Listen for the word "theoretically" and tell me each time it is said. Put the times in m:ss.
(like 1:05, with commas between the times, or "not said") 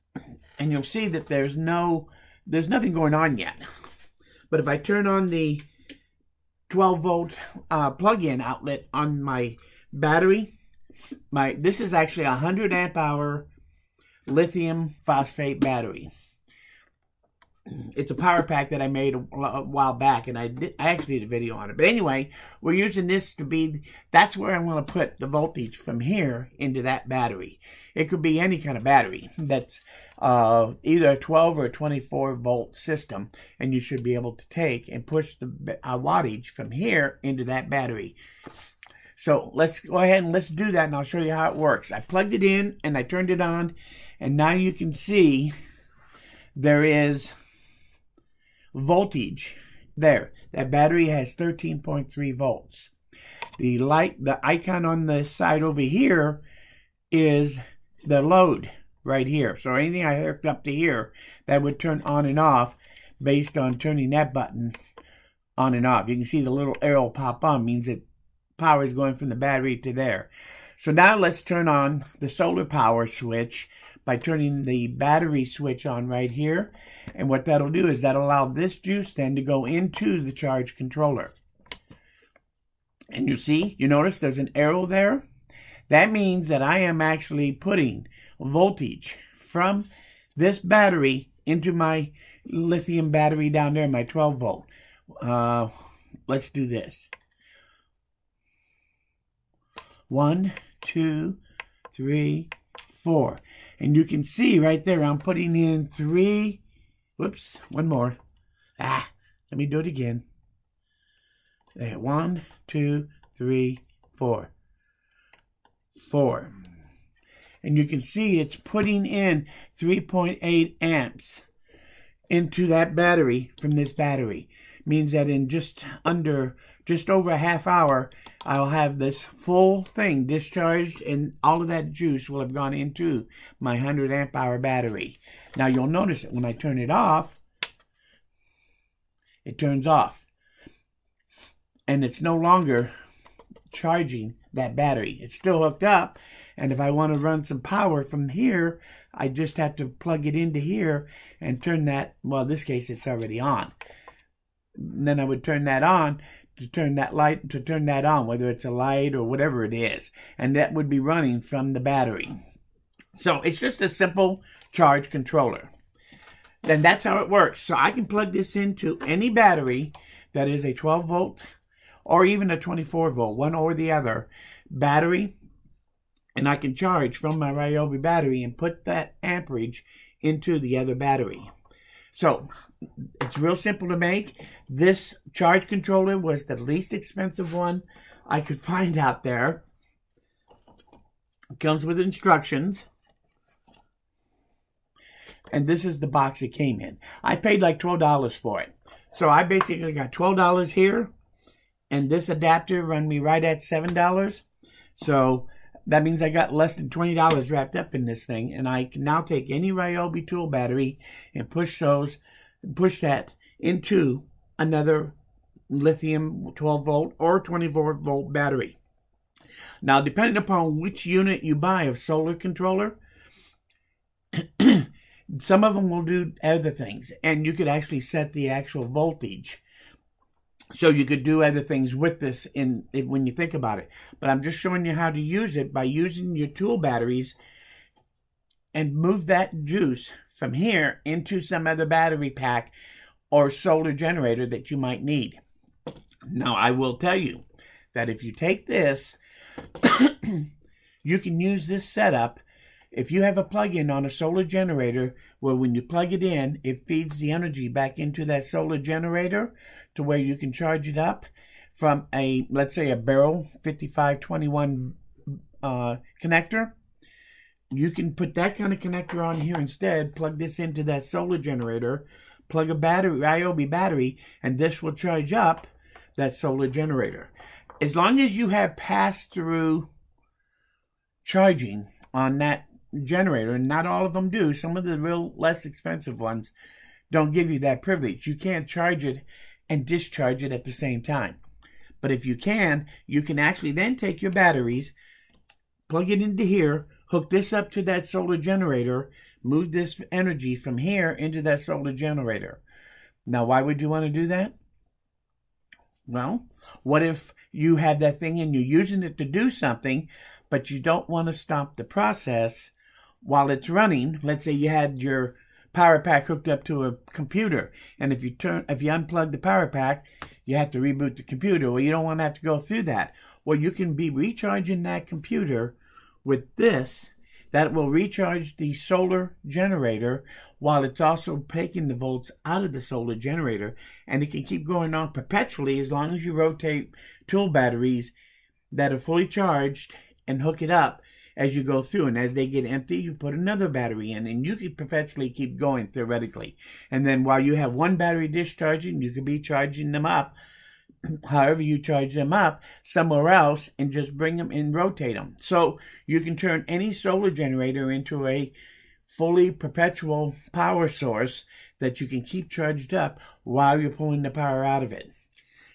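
5:45.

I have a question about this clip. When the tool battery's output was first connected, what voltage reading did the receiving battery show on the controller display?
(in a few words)
13.3 volts.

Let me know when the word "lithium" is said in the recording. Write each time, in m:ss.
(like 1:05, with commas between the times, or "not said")
0:14, 1:32, 3:35.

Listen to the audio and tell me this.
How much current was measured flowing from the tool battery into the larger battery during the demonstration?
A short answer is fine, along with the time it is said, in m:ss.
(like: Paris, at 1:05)
3.8 amps, at 1:59.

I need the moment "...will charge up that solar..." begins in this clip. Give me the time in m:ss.
4:34.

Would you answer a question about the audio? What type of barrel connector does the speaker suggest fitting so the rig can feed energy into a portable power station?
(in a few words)
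5521.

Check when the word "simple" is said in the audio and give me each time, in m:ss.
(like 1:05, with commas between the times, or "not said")
2:43, 3:03.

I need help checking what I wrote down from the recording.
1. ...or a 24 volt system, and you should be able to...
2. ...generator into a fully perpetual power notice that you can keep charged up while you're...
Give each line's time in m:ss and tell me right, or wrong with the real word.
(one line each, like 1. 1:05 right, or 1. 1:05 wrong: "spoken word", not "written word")
1. 0:31 right
2. 5:57 wrong: "source", not "notice".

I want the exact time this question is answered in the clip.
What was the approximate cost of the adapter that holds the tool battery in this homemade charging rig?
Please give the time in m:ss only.
3:23.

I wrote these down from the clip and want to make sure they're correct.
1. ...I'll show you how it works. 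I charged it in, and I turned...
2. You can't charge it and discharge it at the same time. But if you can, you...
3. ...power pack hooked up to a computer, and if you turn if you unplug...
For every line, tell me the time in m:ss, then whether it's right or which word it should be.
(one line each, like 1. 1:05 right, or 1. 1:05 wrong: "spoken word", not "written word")
1. 0:40 wrong: "plugged", not "charged"
2. 4:48 right
3. 5:15 right.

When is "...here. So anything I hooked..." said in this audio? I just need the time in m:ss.
0:59.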